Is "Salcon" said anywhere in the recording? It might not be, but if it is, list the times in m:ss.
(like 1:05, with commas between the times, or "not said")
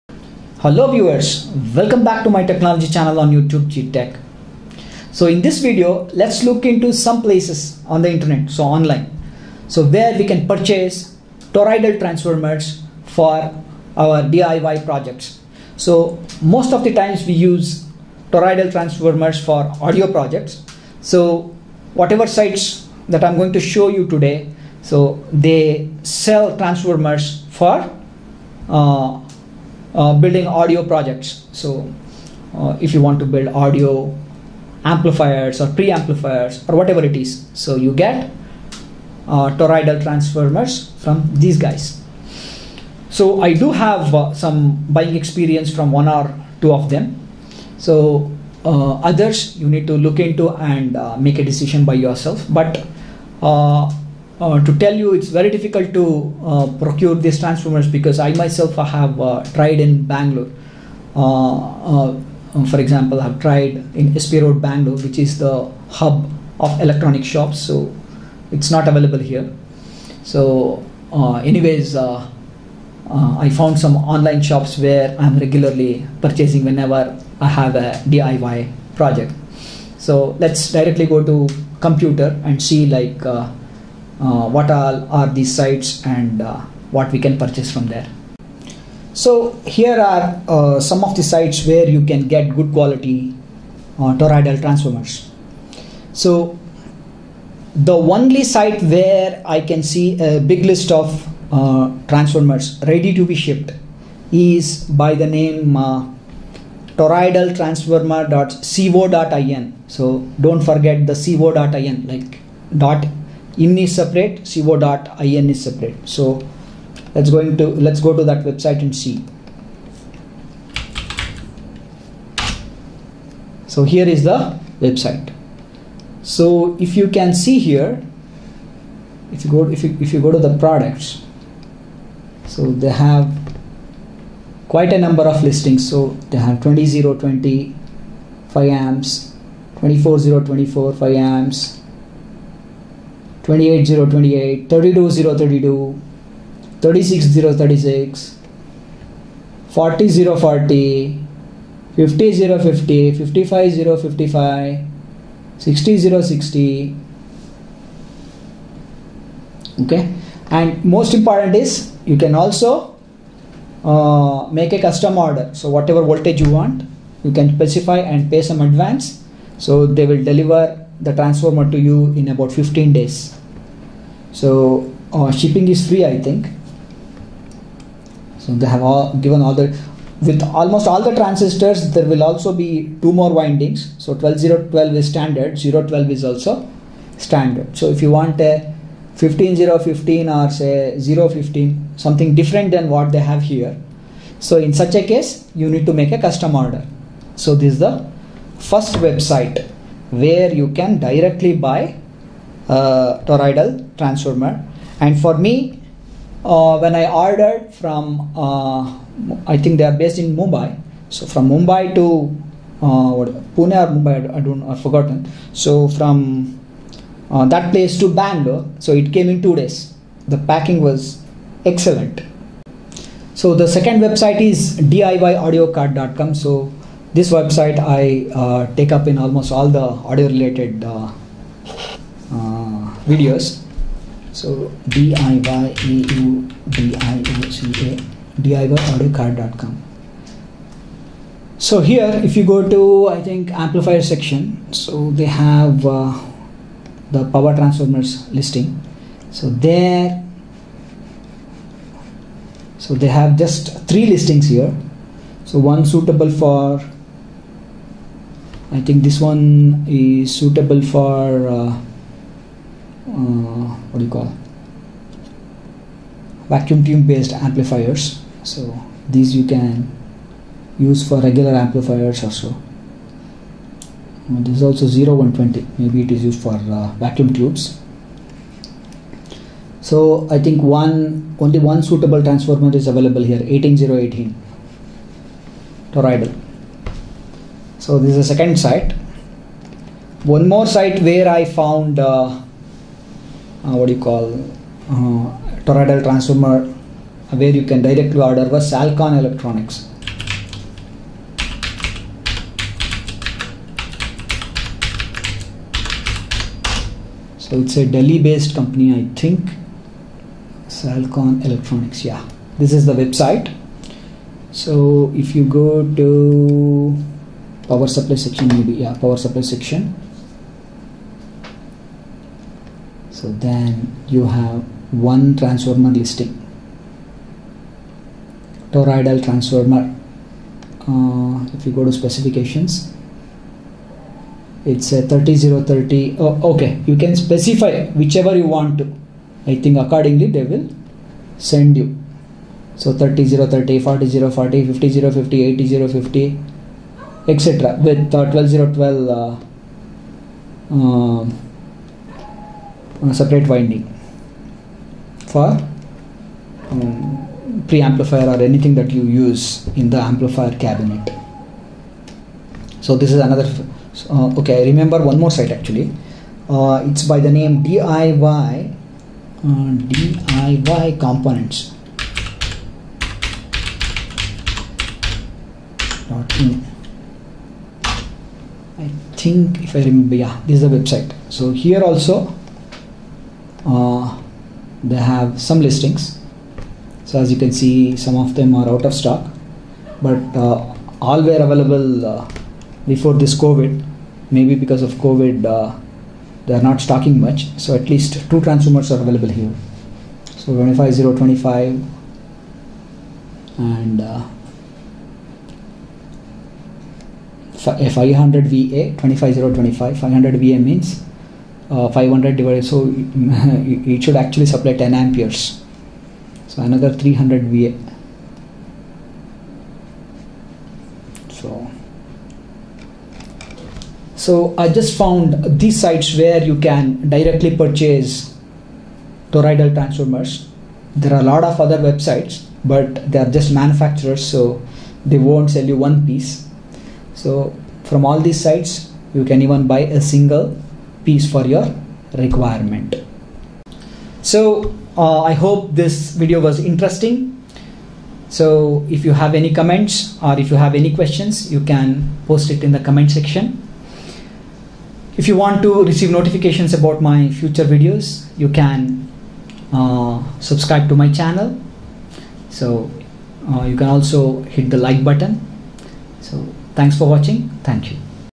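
4:58, 5:10.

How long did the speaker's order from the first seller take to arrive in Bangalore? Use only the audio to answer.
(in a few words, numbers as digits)
2 days.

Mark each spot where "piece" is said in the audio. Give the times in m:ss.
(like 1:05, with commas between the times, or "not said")
7:16, 7:21.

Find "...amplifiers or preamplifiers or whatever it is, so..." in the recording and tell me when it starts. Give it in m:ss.
0:34.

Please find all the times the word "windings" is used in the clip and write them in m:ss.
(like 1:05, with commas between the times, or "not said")
3:03, 5:53.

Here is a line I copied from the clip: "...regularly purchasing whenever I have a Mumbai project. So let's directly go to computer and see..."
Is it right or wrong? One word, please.
wrong.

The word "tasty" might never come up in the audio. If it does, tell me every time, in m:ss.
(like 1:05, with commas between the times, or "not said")
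not said.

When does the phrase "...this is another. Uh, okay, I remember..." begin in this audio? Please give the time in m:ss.
6:02.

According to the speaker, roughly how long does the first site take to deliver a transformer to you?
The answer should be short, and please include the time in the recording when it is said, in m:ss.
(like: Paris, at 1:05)
15 days, at 2:52.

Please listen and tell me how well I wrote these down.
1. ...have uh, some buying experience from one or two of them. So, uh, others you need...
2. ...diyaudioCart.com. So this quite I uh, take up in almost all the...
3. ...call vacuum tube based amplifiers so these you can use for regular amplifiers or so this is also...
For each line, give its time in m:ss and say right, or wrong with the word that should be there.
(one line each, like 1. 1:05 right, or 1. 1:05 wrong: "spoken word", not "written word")
1. 0:43 right
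2. 3:44 wrong: "website", not "quite"
3. 4:24 right.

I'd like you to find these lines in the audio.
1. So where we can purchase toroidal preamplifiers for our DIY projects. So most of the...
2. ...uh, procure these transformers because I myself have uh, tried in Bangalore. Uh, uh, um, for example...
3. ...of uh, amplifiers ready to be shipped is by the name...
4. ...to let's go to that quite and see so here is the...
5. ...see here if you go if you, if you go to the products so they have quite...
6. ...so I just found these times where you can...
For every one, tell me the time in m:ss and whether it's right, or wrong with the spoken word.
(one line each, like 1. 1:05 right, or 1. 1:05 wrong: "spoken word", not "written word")
1. 0:09 wrong: "transformers", not "preamplifiers"
2. 0:56 right
3. 1:40 wrong: "transformers", not "amplifiers"
4. 1:57 wrong: "website", not "quite"
5. 2:07 right
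6. 7:04 wrong: "sites", not "times".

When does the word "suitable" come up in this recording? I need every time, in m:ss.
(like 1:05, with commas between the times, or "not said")
4:15, 4:20, 4:41.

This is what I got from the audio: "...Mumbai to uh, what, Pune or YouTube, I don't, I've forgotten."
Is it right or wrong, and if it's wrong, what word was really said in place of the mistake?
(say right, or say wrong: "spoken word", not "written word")
wrong: "Mumbai", not "YouTube".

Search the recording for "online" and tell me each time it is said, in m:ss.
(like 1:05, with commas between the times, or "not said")
0:08, 1:13.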